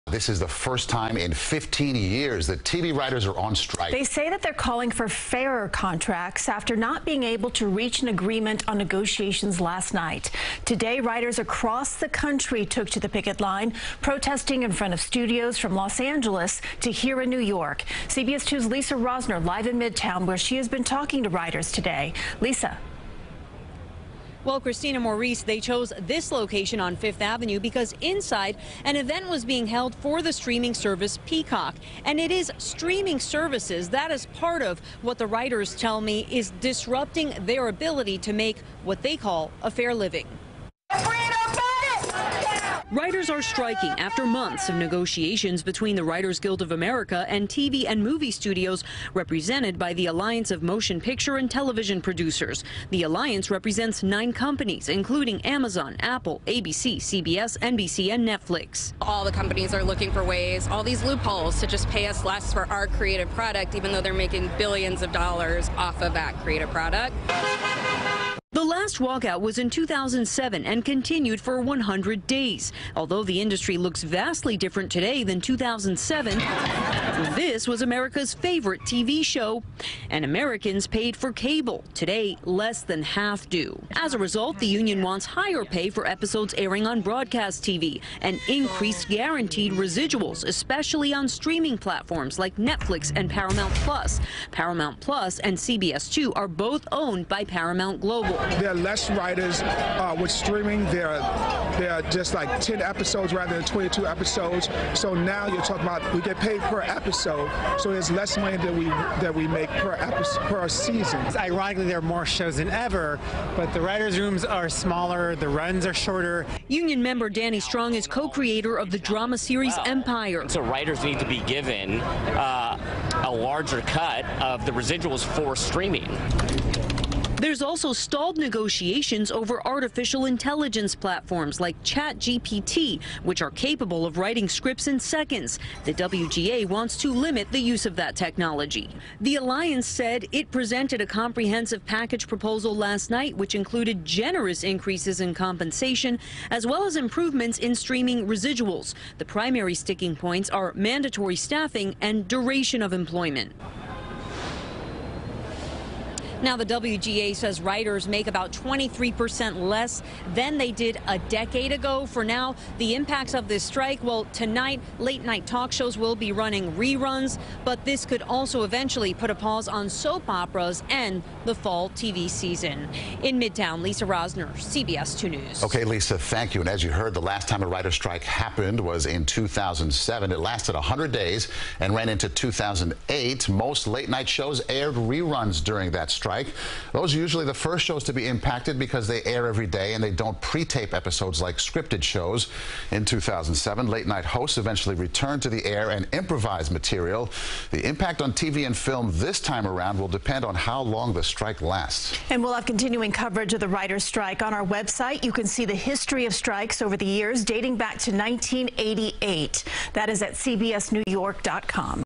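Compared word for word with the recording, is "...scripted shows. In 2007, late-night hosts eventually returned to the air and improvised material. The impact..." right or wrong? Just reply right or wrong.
right.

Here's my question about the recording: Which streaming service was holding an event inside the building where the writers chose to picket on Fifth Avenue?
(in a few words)
Peacock.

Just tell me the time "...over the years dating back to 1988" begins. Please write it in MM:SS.
03:26.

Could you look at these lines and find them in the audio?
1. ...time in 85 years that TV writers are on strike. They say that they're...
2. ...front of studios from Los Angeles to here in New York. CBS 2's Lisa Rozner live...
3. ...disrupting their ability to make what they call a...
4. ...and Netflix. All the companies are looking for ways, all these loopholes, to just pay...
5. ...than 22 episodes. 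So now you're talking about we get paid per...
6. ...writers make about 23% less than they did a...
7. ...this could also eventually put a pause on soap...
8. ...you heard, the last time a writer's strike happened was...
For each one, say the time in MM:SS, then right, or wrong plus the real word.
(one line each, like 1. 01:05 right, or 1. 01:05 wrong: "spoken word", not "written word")
1. 00:00 wrong: "15", not "85"
2. 00:14 right
3. 00:36 right
4. 00:58 right
5. 01:43 right
6. 02:37 right
7. 02:47 right
8. 02:56 right.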